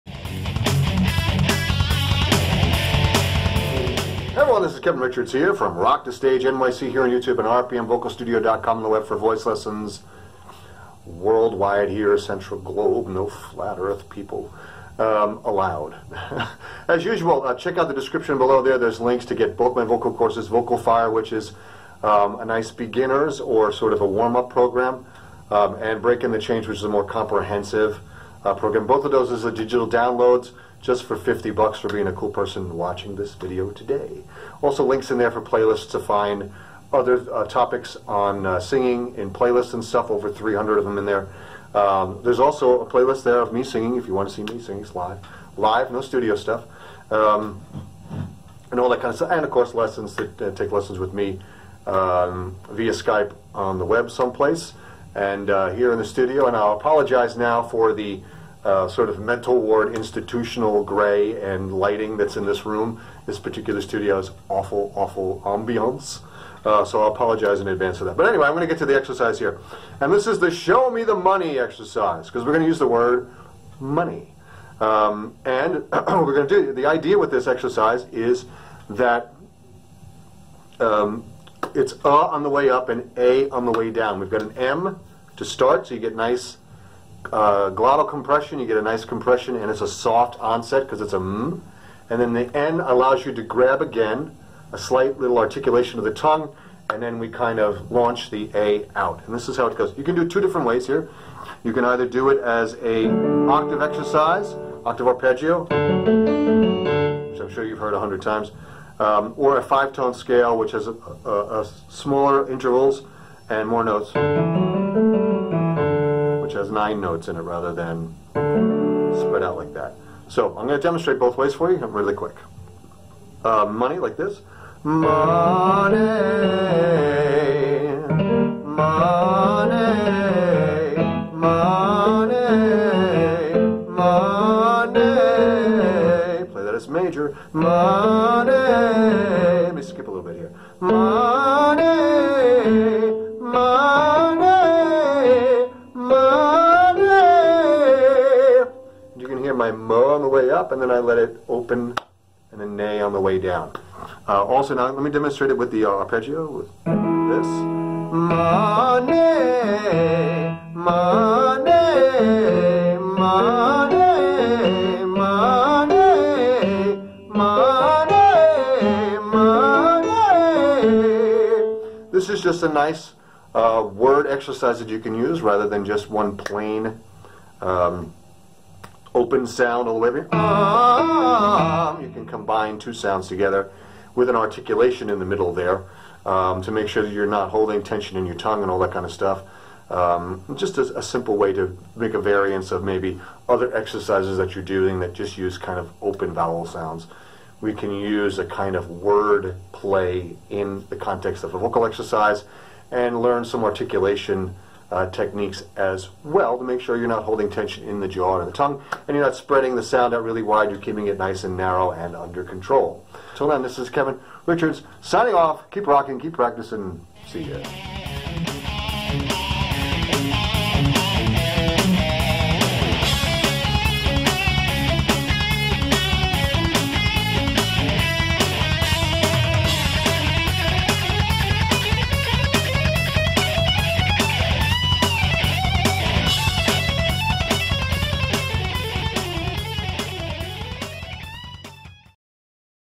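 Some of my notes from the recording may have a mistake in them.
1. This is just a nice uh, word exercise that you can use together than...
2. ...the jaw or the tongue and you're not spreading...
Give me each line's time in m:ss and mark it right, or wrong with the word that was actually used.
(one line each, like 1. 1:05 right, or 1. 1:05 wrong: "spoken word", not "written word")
1. 2:52 wrong: "rather", not "together"
2. 3:27 right.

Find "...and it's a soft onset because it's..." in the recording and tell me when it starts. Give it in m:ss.
1:29.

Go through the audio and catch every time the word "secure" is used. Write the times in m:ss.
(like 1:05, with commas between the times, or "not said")
not said.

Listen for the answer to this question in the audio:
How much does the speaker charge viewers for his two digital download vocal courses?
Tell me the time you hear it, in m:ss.
0:31.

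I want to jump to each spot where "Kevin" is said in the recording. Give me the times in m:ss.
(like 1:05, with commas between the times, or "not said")
0:04, 3:33.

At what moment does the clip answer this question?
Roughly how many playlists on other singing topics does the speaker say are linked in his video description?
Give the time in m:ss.
0:40.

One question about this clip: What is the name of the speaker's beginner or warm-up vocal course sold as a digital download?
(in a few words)
Vocal Fire.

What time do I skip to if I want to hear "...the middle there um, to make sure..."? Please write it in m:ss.
3:05.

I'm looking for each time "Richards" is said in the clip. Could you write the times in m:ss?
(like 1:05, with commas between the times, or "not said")
0:04, 3:34.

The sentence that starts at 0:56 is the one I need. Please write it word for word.
And I'll apologize now for the uh, sort of mental ward institutional gray and lighting that's in this room.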